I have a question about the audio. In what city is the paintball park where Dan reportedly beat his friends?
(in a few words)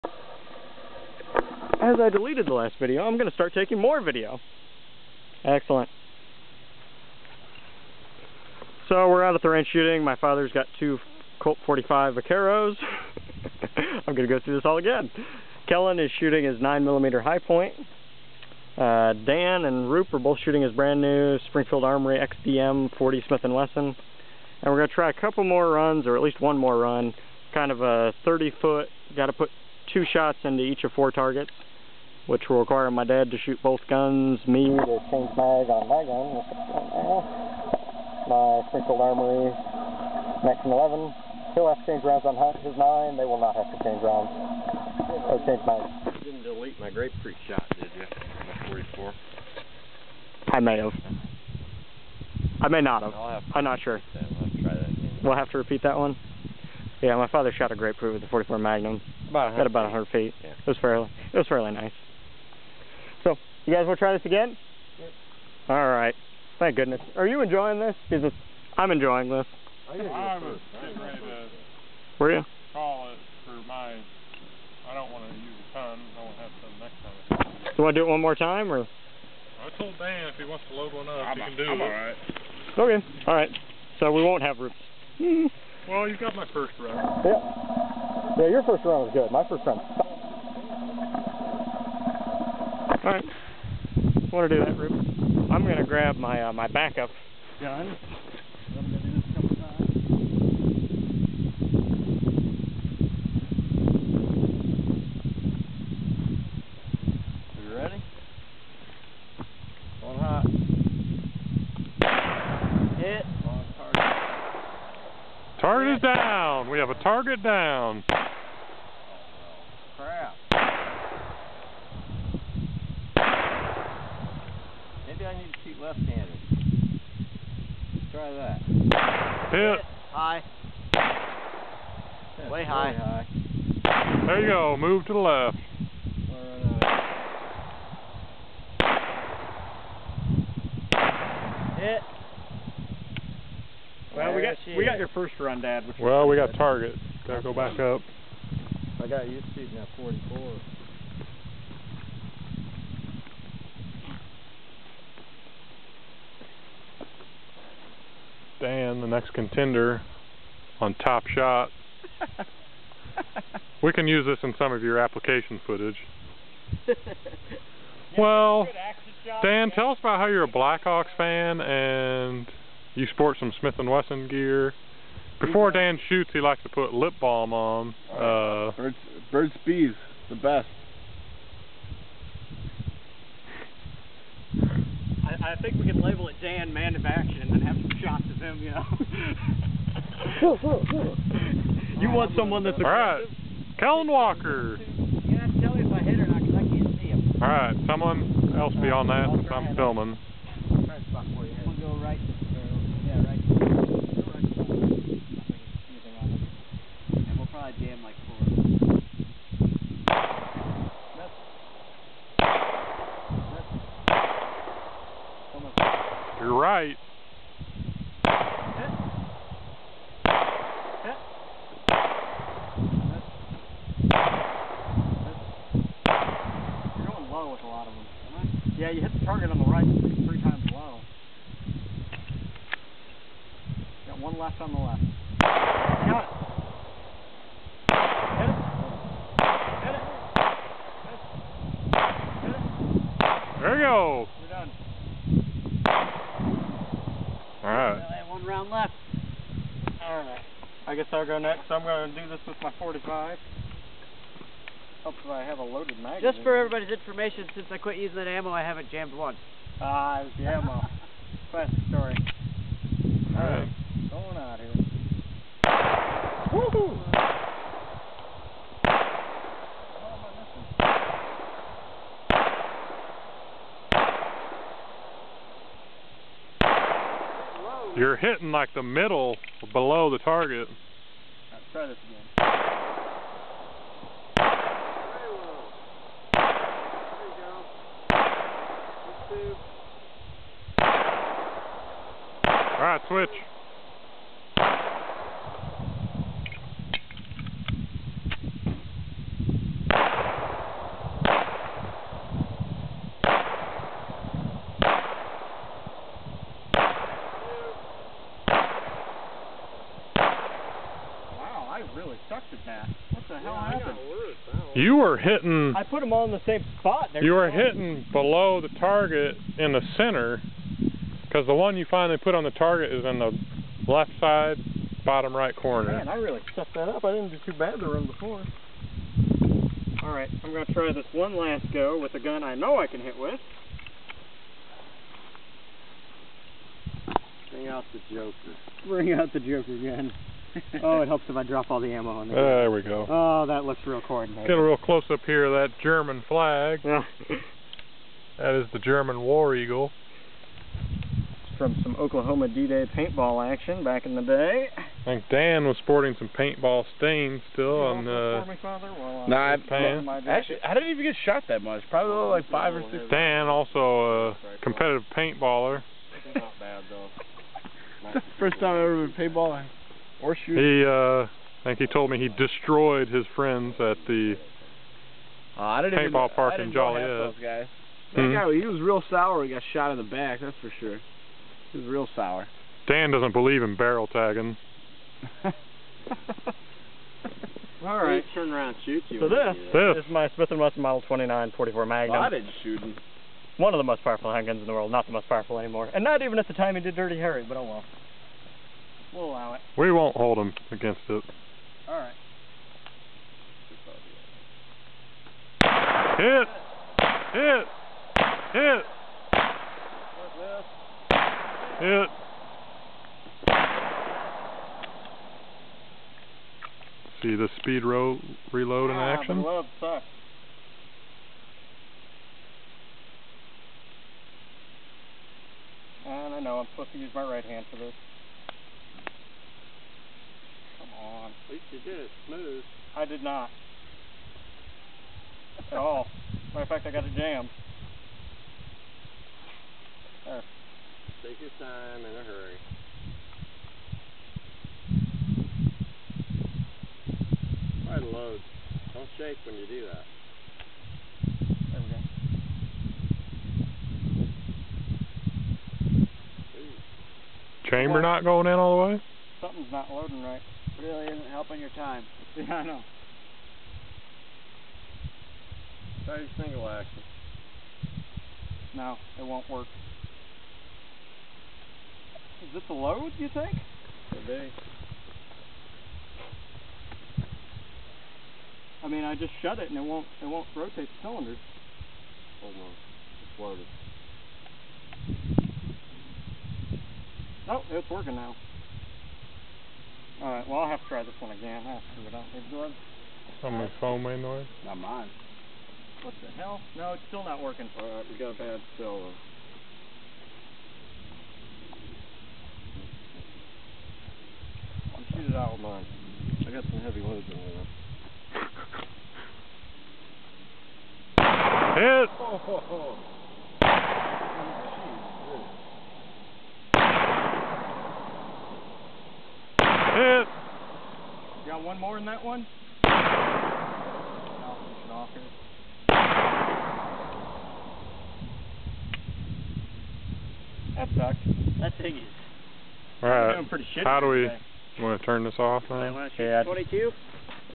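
Joliet.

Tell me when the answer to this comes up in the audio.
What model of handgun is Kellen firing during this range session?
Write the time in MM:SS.
00:16.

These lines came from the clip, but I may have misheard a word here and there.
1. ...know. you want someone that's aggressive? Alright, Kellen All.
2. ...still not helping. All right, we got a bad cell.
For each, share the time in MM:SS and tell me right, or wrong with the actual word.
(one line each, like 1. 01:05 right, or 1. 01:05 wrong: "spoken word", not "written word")
1. 03:10 wrong: "Walker", not "All"
2. 08:17 wrong: "working", not "helping".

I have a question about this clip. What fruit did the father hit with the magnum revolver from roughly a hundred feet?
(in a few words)
Grapefruit.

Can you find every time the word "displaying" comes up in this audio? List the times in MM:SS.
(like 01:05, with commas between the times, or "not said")
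not said.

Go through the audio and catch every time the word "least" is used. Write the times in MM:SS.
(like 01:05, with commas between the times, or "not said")
00:26, 07:11.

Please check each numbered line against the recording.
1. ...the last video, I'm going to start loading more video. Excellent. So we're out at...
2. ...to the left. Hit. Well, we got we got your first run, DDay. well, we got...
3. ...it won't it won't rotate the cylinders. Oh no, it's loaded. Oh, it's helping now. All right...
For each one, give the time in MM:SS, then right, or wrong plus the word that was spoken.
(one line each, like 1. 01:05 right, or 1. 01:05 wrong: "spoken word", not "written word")
1. 00:02 wrong: "taking", not "loading"
2. 02:15 wrong: "Dad", not "DDay"
3. 07:59 wrong: "working", not "helping".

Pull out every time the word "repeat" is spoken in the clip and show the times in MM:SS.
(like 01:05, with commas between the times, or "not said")
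00:55.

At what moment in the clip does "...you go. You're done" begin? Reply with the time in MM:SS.
04:03.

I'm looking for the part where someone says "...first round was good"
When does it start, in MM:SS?
01:28.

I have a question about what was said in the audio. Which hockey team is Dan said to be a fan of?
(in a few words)
Blackhawks.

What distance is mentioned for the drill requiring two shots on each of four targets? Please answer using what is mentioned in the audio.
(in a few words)
30 feet.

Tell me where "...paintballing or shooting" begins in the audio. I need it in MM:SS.
06:09.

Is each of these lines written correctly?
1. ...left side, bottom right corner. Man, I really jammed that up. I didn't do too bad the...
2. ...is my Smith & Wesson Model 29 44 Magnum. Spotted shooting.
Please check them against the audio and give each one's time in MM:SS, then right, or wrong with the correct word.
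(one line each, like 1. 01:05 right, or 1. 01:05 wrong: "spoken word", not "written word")
1. 05:23 wrong: "stuffed", not "jammed"
2. 06:30 right.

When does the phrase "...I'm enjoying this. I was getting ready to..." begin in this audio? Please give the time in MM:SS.
01:08.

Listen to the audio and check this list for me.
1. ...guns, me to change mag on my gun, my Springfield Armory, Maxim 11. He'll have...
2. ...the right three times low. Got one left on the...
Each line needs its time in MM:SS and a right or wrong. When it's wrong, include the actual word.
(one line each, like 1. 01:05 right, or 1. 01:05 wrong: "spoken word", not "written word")
1. 00:33 right
2. 03:49 right.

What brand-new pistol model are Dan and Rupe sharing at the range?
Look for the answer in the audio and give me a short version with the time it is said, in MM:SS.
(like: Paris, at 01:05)
Springfield Armory XDM, at 00:21.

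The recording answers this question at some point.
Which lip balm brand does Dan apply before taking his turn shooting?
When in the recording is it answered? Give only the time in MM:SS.
02:59.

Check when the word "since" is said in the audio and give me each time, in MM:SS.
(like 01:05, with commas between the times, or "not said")
03:19, 04:17.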